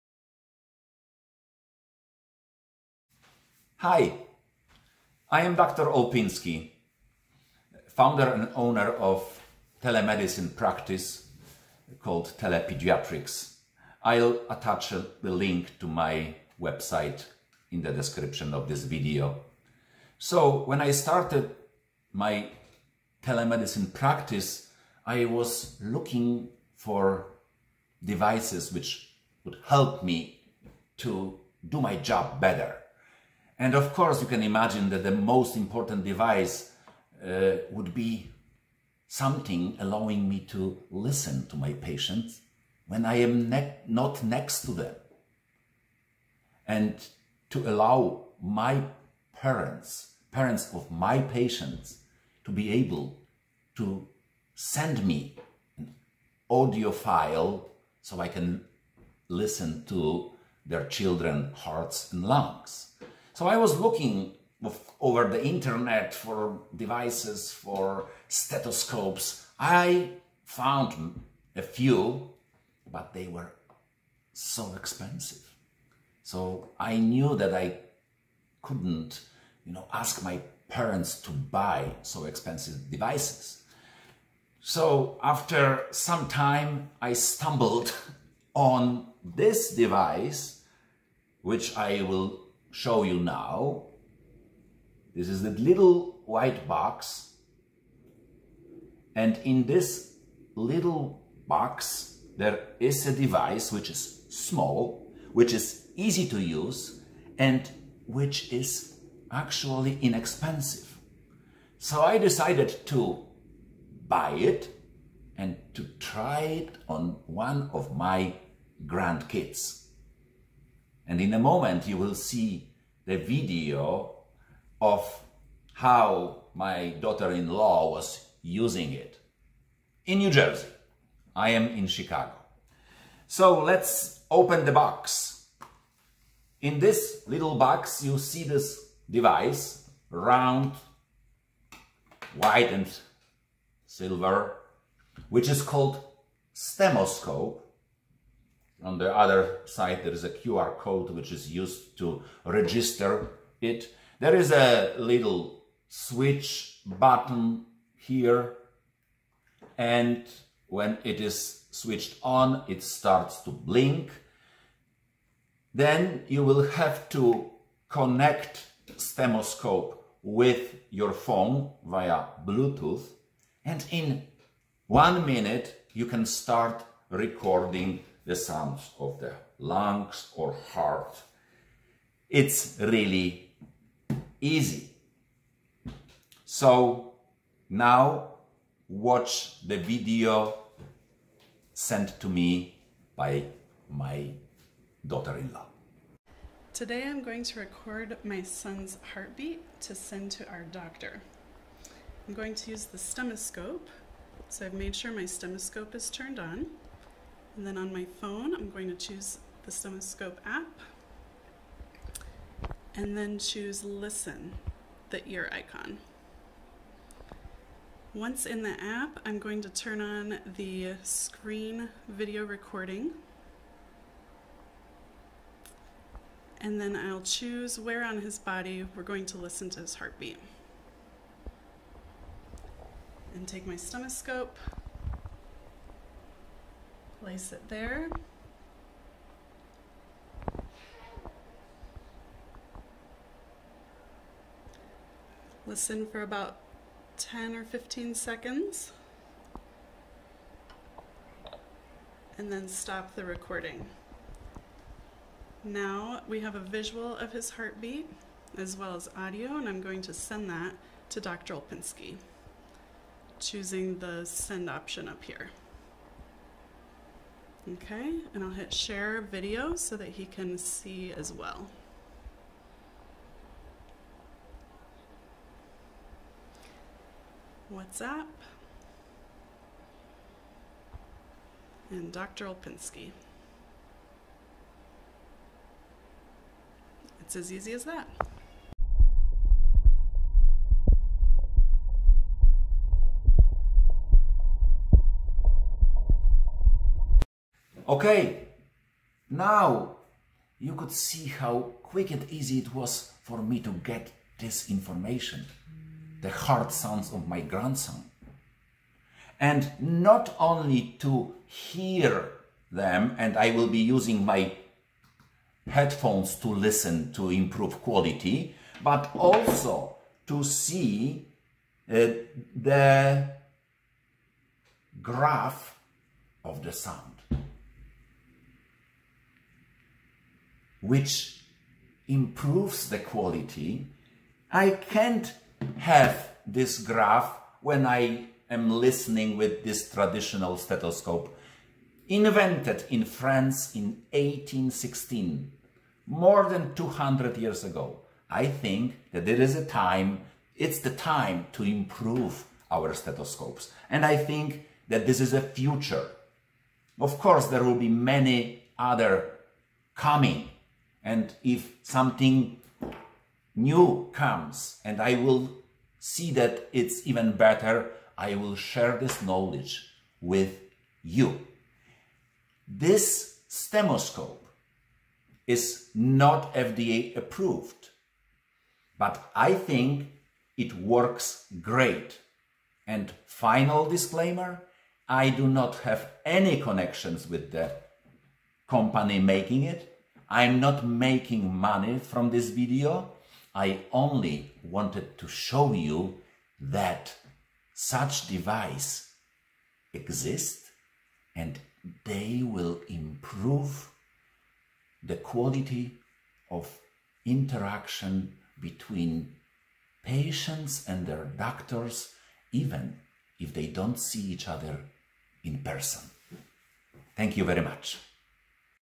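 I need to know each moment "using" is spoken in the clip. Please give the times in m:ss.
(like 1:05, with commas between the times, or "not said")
2:08, 5:13.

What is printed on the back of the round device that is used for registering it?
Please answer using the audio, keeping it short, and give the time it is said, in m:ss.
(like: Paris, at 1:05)
QR code, at 2:30.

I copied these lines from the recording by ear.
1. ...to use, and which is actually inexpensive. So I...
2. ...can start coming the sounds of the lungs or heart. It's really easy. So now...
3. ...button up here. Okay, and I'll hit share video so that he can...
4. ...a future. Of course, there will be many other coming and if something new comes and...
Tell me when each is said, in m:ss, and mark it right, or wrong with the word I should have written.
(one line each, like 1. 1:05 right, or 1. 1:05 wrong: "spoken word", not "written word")
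1. 1:46 right
2. 2:56 wrong: "recording", not "coming"
3. 4:24 wrong: "option", not "button"
4. 5:55 right.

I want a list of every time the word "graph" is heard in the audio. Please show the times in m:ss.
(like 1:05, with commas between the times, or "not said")
5:25, 5:36.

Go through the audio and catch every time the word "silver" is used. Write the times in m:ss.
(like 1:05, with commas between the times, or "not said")
2:23.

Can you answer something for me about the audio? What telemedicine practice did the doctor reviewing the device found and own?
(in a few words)
Telepediatrics.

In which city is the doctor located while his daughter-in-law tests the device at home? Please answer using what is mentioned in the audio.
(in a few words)
Chicago.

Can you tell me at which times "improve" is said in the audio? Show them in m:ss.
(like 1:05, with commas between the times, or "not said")
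5:17, 5:32, 5:51, 6:42.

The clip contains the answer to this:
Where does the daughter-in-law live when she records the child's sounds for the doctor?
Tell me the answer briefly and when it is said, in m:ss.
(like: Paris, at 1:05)
New Jersey, at 2:10.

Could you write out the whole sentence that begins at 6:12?
This stemoscope is not FDA approved, but I think it works great.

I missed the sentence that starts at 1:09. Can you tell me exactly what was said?
I found a few, but they were so expensive.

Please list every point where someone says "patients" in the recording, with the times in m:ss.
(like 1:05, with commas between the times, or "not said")
0:41, 0:51, 6:50.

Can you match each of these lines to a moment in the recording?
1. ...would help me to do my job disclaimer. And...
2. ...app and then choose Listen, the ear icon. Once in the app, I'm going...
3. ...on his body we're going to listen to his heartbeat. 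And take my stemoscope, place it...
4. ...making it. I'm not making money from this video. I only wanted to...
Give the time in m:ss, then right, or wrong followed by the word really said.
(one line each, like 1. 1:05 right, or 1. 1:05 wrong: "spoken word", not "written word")
1. 0:29 wrong: "better", not "disclaimer"
2. 3:30 right
3. 3:48 right
4. 6:29 right.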